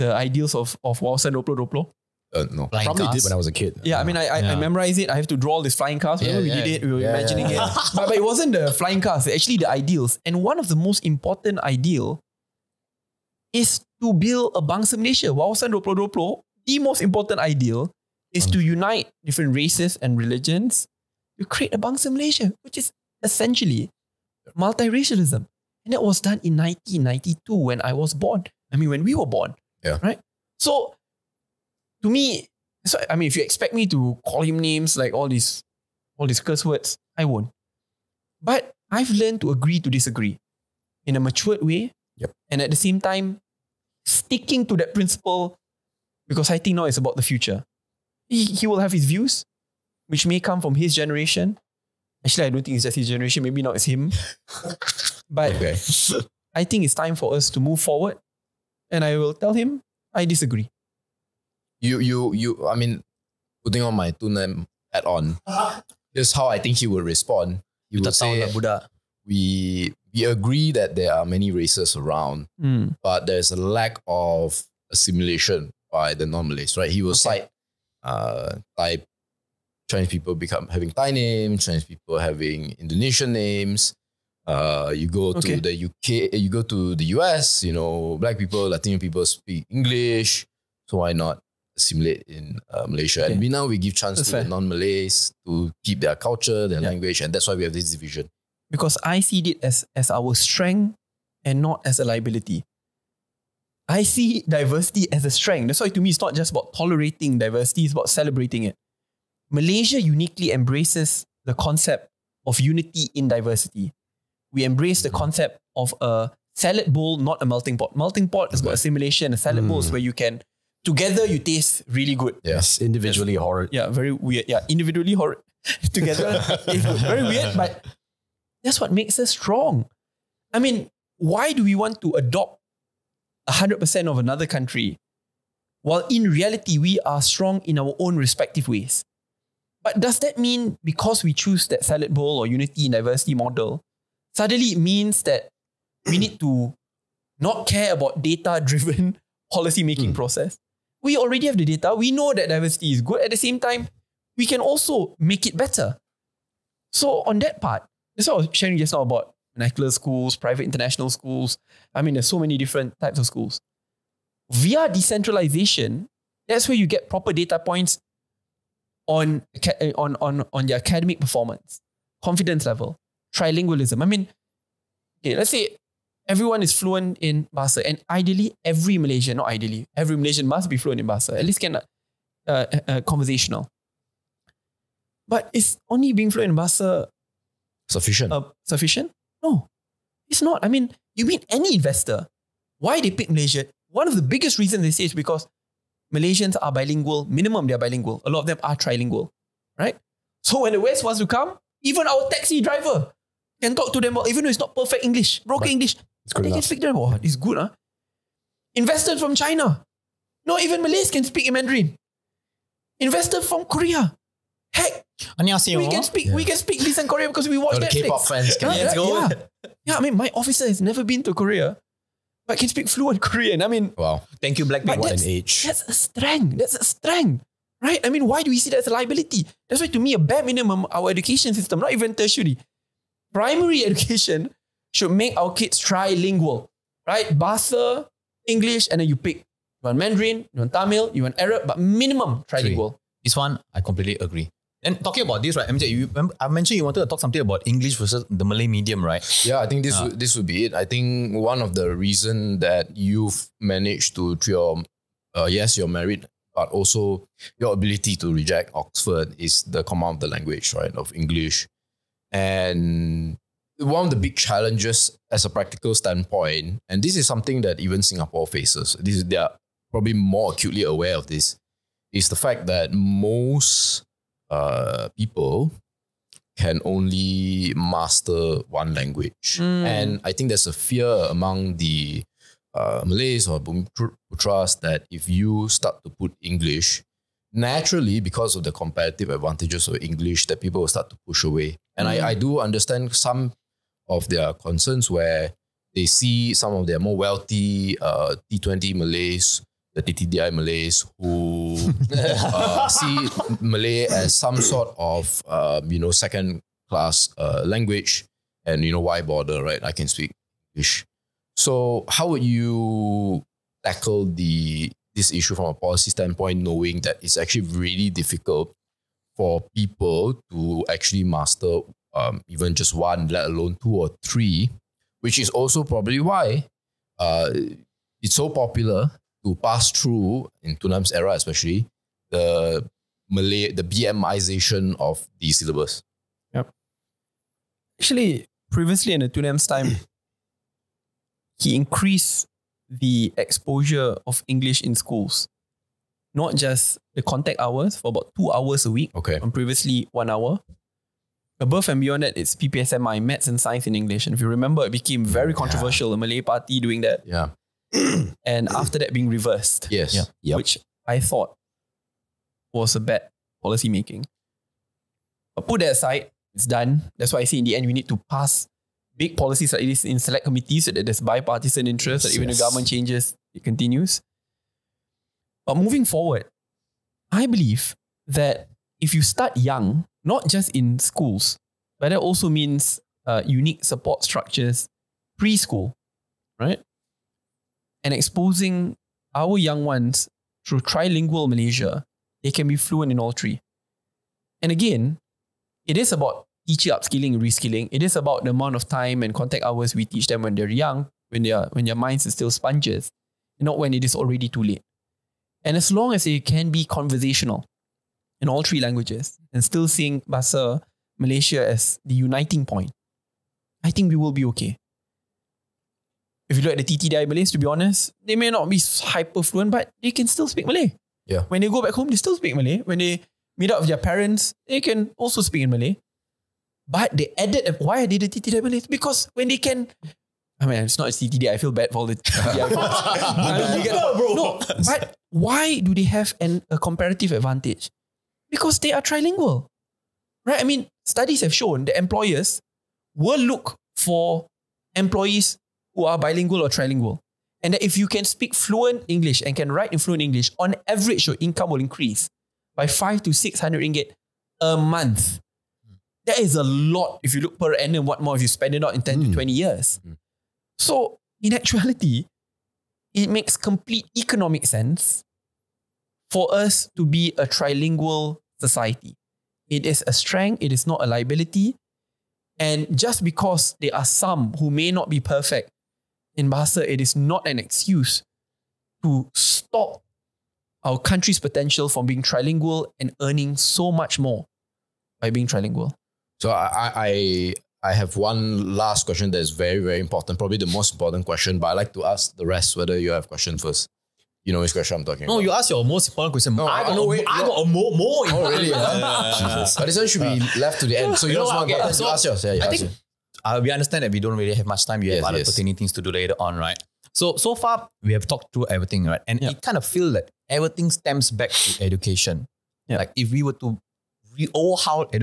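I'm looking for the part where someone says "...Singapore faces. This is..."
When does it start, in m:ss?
4:28.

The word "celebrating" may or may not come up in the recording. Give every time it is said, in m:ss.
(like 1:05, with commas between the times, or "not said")
1:48.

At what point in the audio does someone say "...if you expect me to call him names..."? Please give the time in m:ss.
0:33.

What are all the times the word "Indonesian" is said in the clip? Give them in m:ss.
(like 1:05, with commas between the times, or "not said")
1:22.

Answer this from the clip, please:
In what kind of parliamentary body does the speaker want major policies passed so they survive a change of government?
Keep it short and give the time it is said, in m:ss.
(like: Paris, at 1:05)
select committees, at 6:10.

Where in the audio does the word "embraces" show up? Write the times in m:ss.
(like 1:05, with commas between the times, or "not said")
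1:50, 1:54.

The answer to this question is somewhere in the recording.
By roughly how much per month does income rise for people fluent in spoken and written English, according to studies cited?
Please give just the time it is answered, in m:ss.
7:32.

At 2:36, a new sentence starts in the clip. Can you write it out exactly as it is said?
So, on that part, that's what I was sharing just now about vernacular schools, private international schools.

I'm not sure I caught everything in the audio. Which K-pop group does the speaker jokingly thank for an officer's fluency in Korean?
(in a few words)
Blackpink.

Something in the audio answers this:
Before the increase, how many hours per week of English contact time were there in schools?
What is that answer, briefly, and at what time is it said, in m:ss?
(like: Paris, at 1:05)
1 hour, at 5:50.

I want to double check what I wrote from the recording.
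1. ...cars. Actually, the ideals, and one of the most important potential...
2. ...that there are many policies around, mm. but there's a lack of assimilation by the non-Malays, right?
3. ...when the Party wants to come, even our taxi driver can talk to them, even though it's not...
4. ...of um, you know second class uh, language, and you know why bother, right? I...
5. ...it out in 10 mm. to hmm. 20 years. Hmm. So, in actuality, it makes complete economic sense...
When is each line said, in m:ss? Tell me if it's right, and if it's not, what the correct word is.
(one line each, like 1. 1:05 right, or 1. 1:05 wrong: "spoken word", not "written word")
1. 0:09 wrong: "ideal", not "potential"
2. 1:10 wrong: "races", not "policies"
3. 3:20 wrong: "West", not "Party"
4. 5:04 right
5. 7:38 right.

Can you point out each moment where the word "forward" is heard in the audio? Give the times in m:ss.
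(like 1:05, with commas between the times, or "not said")
0:57, 6:16.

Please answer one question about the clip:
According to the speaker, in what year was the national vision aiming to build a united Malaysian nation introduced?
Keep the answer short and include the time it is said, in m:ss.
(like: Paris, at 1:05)
1992, at 0:26.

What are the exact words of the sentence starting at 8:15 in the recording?
No, you ask your most important question.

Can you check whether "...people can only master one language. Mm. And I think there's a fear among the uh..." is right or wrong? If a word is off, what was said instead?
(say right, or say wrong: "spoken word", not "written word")
right.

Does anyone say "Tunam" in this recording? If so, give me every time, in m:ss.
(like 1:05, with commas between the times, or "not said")
5:30, 5:39.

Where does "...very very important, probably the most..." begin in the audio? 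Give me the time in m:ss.
8:09.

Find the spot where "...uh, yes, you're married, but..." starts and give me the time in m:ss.
4:15.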